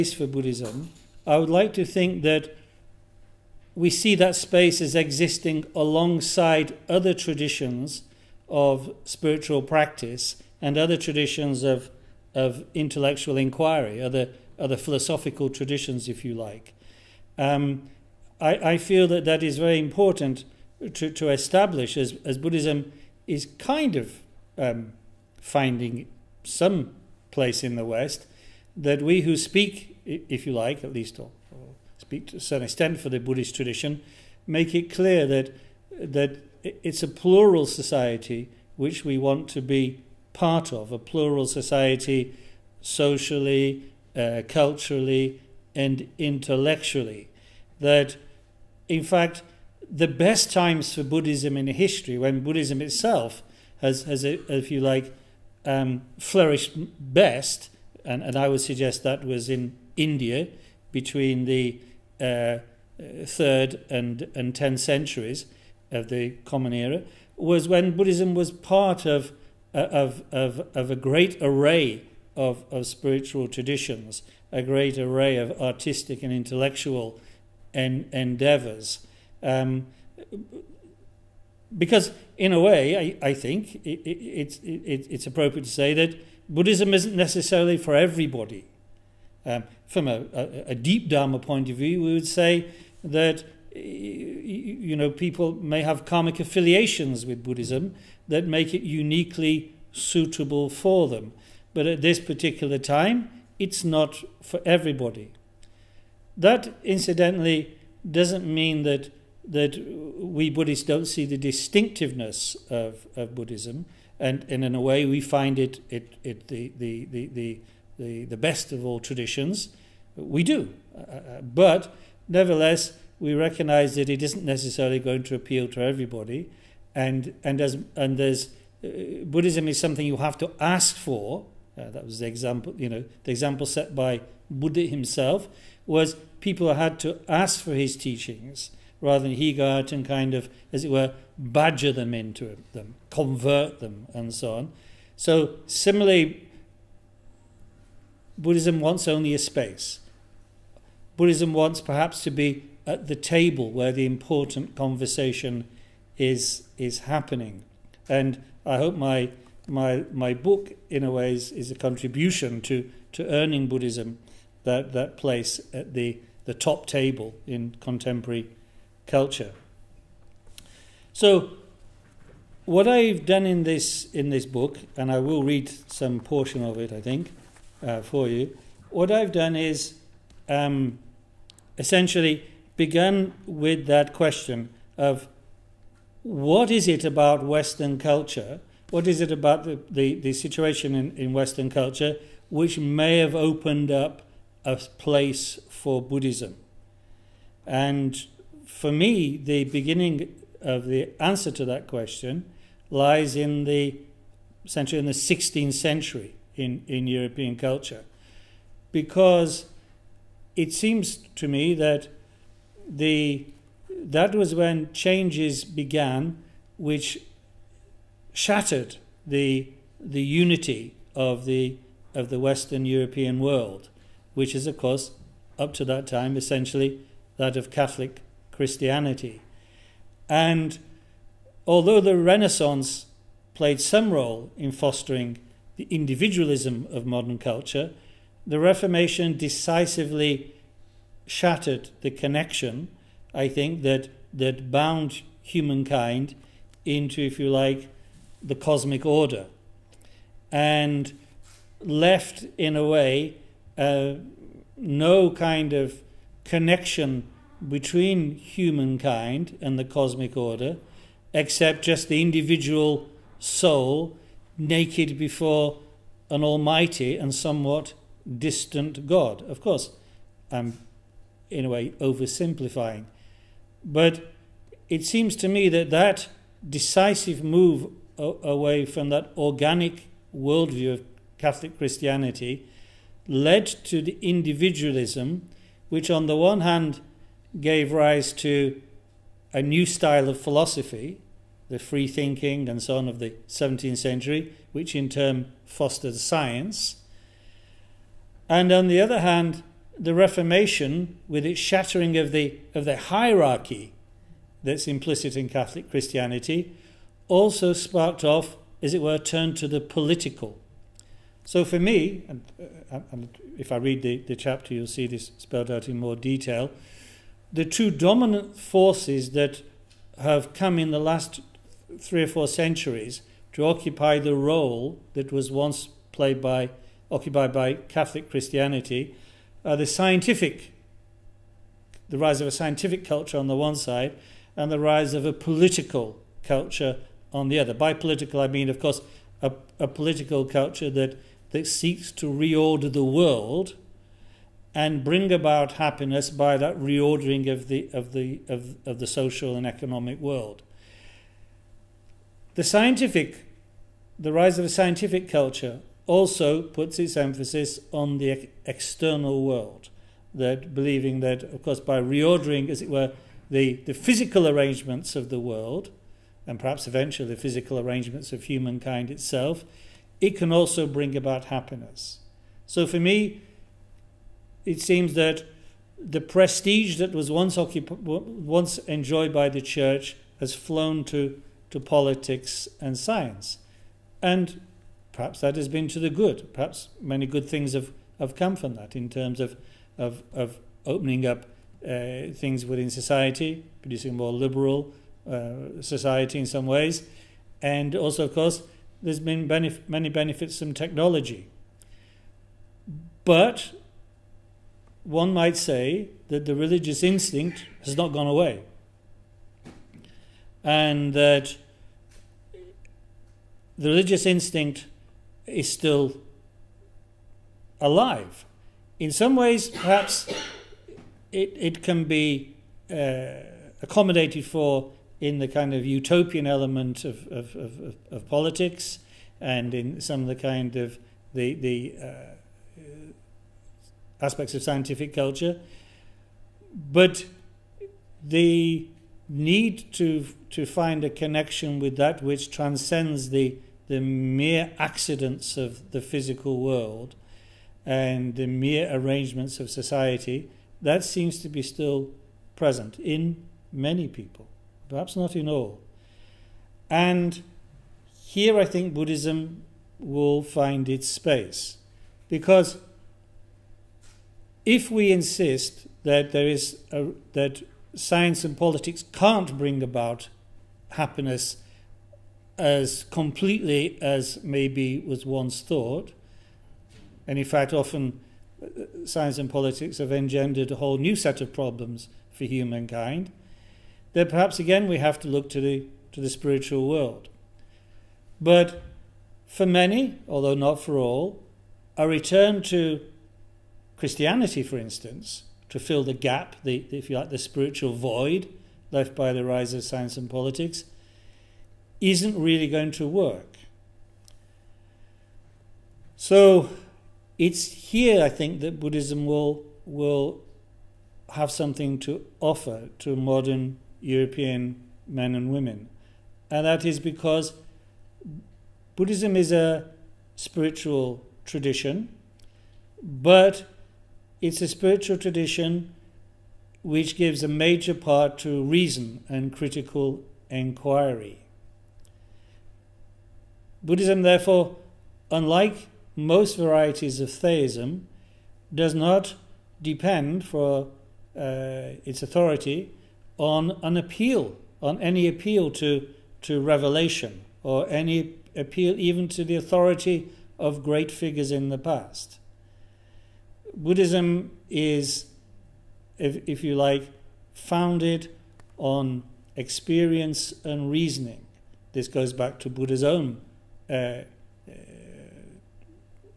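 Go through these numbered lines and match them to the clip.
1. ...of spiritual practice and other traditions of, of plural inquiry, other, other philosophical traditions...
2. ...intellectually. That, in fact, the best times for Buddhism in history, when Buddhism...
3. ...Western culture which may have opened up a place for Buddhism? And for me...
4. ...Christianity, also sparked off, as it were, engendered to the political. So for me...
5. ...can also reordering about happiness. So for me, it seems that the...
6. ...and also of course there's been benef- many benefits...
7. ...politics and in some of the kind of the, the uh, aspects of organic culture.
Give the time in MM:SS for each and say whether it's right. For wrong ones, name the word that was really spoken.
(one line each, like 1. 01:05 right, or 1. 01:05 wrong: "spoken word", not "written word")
1. 00:08 wrong: "intellectual", not "plural"
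2. 00:46 right
3. 03:11 right
4. 05:05 wrong: "turned", not "engendered"
5. 06:10 wrong: "bring", not "reordering"
6. 06:37 right
7. 07:08 wrong: "scientific", not "organic".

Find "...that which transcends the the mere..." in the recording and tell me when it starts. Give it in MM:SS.
07:21.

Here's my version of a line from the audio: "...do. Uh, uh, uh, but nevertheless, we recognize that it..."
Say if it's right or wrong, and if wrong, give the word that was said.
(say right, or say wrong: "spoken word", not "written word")
right.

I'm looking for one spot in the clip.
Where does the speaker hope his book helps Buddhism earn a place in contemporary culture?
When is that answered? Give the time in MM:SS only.
02:46.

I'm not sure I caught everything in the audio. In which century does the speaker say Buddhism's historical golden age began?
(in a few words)
3rd.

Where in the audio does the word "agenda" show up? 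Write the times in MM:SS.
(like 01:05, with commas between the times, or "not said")
not said.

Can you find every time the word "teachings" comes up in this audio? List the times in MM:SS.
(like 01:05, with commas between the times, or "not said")
02:17.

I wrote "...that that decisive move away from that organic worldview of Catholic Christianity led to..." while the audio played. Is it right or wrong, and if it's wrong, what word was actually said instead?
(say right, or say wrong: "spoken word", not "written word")
right.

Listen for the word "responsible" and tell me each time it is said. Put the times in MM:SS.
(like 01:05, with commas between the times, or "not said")
not said.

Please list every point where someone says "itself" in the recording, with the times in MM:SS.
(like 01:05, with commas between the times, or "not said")
00:52, 06:09.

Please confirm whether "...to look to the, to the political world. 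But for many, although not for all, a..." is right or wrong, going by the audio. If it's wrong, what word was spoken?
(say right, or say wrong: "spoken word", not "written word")
wrong: "spiritual", not "political".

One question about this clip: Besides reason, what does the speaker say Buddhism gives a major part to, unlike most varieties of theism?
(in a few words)
critical inquiry.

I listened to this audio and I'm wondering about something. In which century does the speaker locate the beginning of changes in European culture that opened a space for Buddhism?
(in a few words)
16th century.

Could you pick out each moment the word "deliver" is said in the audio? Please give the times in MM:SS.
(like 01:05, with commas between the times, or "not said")
not said.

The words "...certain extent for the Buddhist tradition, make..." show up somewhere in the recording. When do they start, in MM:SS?
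00:32.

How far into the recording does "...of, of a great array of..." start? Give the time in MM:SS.
01:10.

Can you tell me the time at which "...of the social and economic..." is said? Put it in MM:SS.
05:48.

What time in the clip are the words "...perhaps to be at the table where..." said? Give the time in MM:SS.
02:31.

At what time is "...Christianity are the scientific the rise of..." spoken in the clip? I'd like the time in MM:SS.
05:28.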